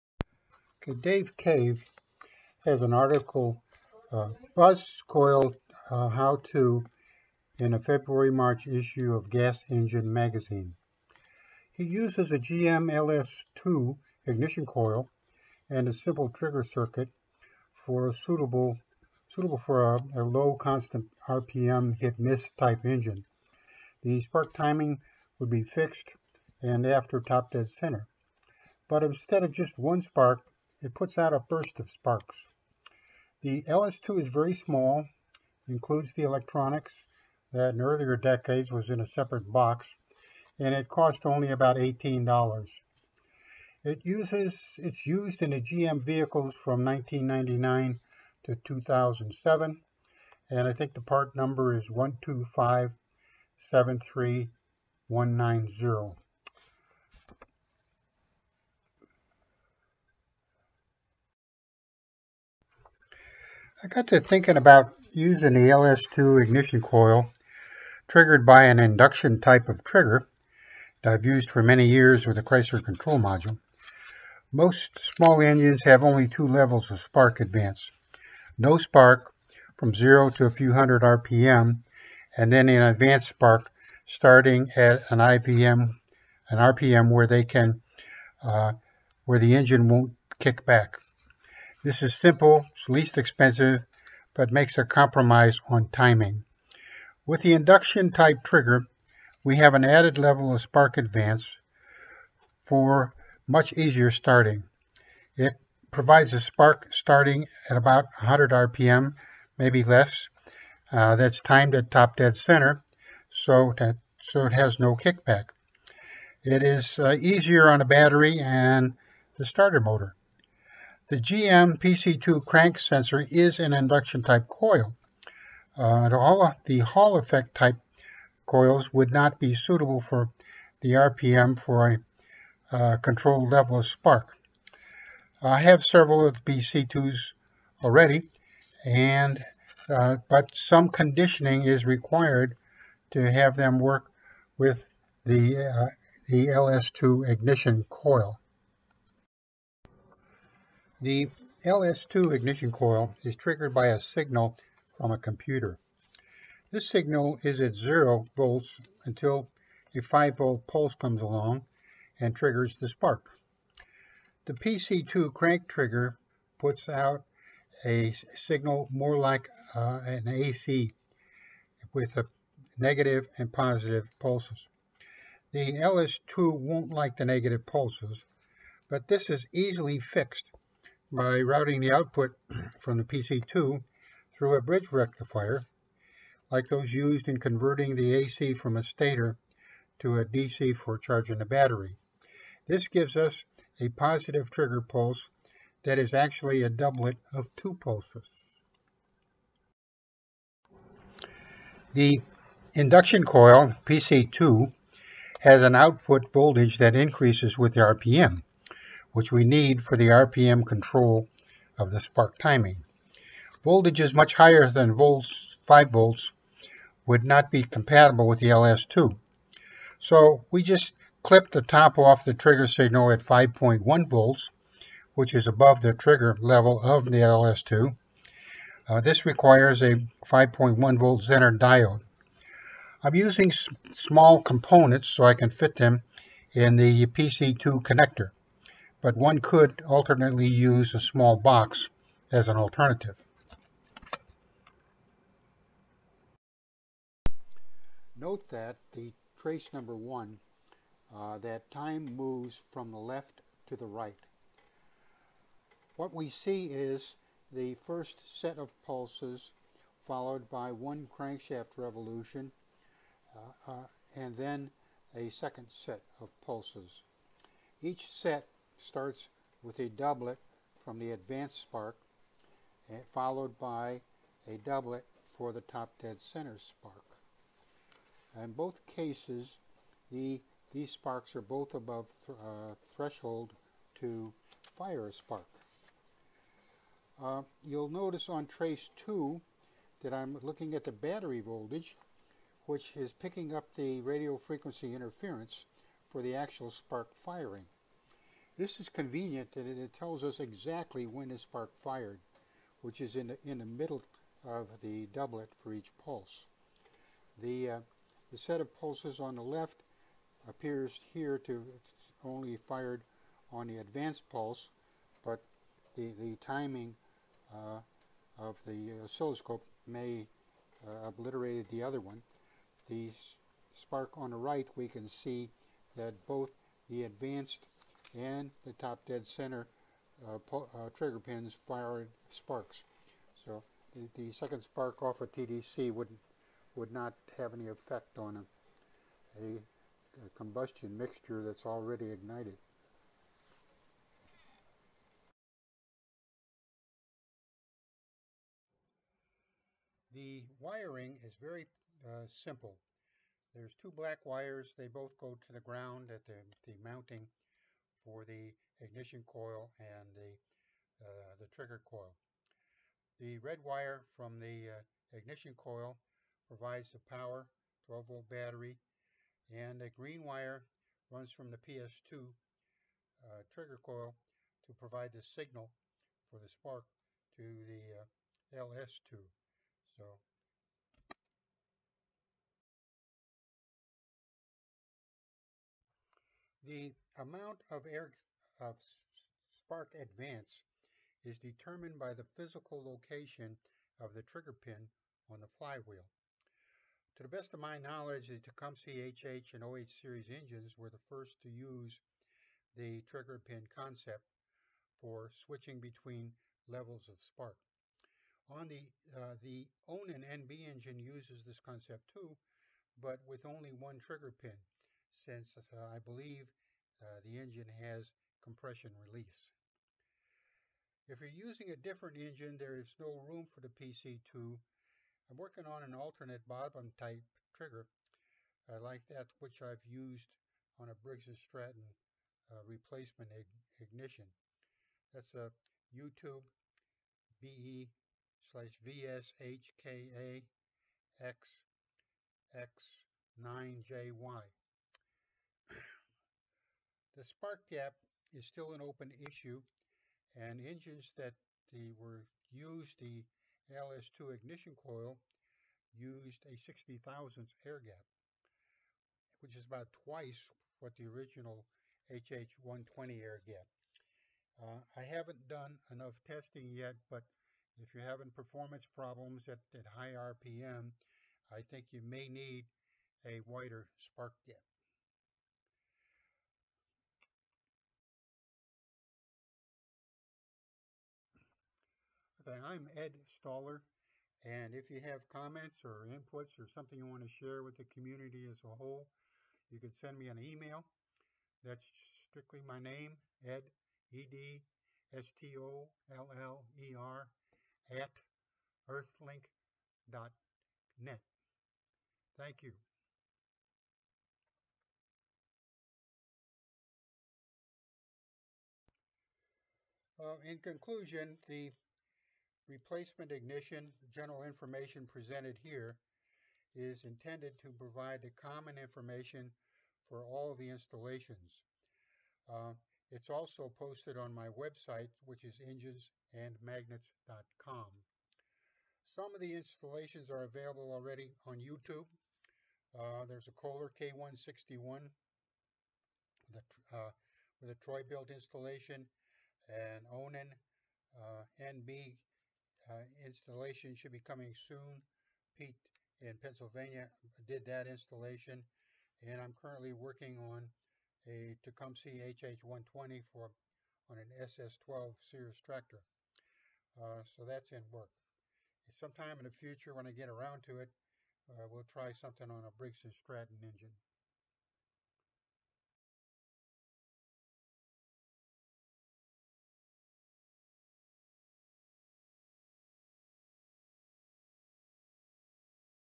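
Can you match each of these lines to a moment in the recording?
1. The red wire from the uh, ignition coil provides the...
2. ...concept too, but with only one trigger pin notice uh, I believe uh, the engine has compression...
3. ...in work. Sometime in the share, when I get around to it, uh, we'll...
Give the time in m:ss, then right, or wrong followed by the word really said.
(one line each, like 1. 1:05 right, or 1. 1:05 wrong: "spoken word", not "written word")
1. 6:03 right
2. 6:51 wrong: "since", not "notice"
3. 9:17 wrong: "future", not "share".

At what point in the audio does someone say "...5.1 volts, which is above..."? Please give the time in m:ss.
3:43.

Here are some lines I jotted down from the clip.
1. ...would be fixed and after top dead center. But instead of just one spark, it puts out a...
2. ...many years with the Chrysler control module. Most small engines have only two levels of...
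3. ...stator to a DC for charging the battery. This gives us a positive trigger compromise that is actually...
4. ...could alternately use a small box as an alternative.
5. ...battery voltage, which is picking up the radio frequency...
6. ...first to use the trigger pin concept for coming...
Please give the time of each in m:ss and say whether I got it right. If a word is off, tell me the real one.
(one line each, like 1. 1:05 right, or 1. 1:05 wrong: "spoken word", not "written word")
1. 0:25 right
2. 1:11 right
3. 3:08 wrong: "pulse", not "compromise"
4. 3:59 right
5. 4:50 right
6. 6:41 wrong: "switching", not "coming".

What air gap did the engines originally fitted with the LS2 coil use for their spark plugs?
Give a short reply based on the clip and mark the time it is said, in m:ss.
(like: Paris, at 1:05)
0.060 inch, at 7:36.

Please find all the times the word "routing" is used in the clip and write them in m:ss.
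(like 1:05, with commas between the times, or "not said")
3:01.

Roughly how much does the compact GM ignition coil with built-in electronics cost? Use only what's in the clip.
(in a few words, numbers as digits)
$18.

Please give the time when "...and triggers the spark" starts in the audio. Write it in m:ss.
2:42.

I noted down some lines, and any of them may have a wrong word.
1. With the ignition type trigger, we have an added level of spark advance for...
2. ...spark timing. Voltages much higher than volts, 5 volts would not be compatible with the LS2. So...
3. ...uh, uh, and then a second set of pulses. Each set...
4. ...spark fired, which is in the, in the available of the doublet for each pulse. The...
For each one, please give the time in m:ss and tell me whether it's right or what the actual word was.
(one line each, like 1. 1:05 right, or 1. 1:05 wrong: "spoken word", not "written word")
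1. 1:37 wrong: "induction", not "ignition"
2. 3:31 right
3. 4:23 right
4. 5:01 wrong: "middle", not "available".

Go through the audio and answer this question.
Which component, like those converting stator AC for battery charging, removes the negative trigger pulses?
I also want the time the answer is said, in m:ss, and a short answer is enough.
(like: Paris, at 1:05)
bridge rectifier, at 3:04.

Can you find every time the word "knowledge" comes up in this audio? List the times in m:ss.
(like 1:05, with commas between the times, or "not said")
6:37.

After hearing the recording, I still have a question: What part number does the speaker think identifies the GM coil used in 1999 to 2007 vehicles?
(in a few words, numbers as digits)
12573190.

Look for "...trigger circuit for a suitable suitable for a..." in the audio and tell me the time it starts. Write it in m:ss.
0:16.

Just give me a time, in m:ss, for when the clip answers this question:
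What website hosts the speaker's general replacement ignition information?
8:45.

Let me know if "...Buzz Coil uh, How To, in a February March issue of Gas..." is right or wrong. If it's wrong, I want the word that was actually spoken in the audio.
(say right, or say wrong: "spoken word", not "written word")
right.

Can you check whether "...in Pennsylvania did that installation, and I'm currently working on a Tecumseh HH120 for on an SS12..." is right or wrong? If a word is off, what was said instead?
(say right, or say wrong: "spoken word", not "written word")
right.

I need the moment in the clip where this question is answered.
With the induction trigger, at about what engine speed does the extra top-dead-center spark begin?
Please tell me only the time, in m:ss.
1:48.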